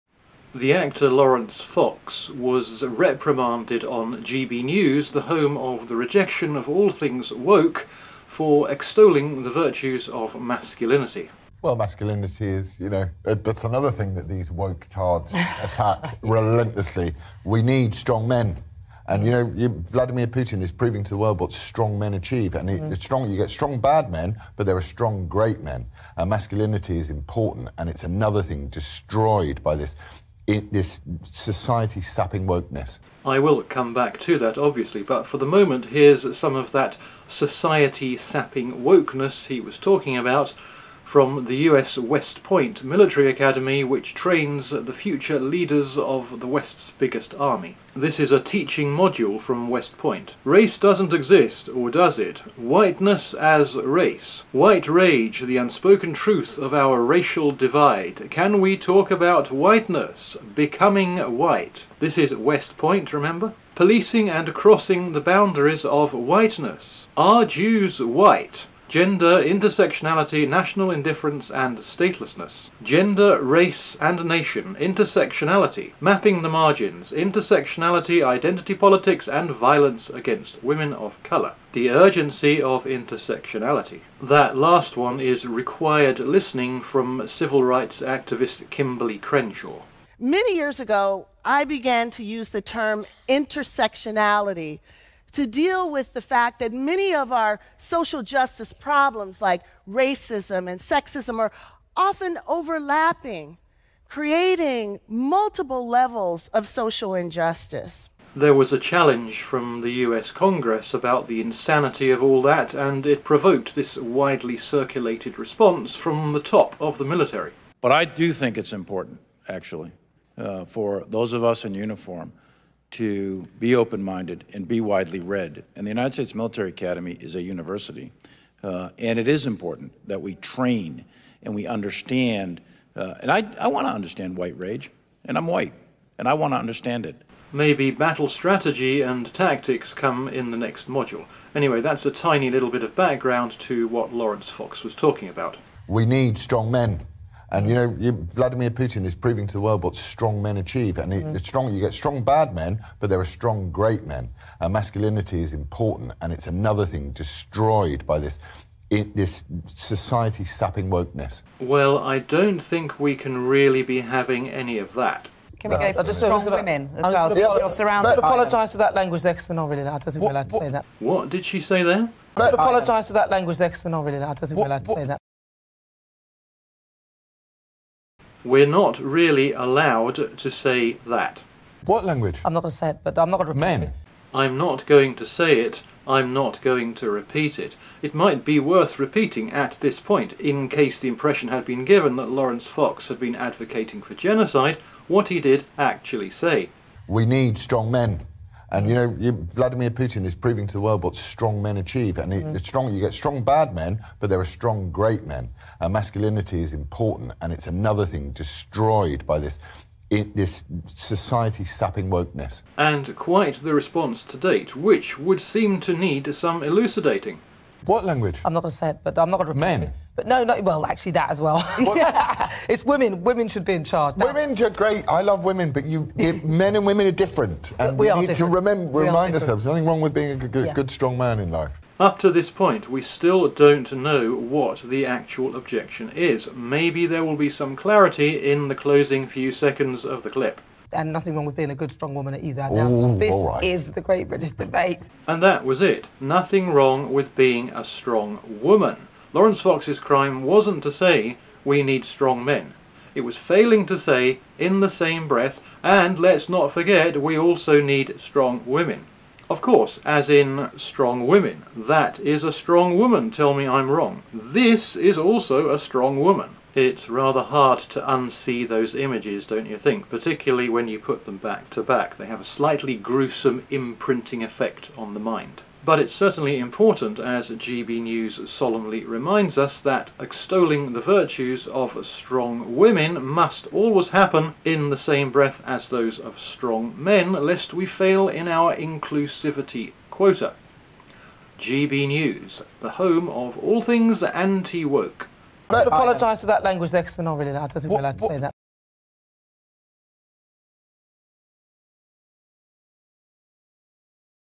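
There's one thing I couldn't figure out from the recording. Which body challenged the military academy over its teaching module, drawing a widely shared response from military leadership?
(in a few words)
US Congress.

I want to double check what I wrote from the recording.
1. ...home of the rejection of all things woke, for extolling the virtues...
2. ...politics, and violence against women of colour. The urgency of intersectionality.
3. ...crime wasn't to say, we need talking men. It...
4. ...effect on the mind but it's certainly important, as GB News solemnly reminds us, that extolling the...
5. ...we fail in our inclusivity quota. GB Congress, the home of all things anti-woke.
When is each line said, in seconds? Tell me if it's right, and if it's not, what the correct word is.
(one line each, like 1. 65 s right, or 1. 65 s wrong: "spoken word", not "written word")
1. 5 s right
2. 78 s right
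3. 249 s wrong: "strong", not "talking"
4. 274 s right
5. 287 s wrong: "News", not "Congress".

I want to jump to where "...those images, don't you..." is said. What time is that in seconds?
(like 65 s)
268 s.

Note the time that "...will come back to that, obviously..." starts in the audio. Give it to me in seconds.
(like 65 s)
33 s.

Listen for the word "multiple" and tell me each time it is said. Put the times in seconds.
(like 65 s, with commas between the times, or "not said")
105 s.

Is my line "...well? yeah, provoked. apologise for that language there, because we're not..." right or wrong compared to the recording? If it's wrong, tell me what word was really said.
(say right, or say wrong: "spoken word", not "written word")
wrong: "surrounded", not "provoked".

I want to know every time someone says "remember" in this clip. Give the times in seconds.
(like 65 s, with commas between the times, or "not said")
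63 s, 228 s.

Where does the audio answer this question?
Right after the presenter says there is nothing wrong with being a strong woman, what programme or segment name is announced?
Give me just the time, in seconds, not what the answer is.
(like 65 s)
244 s.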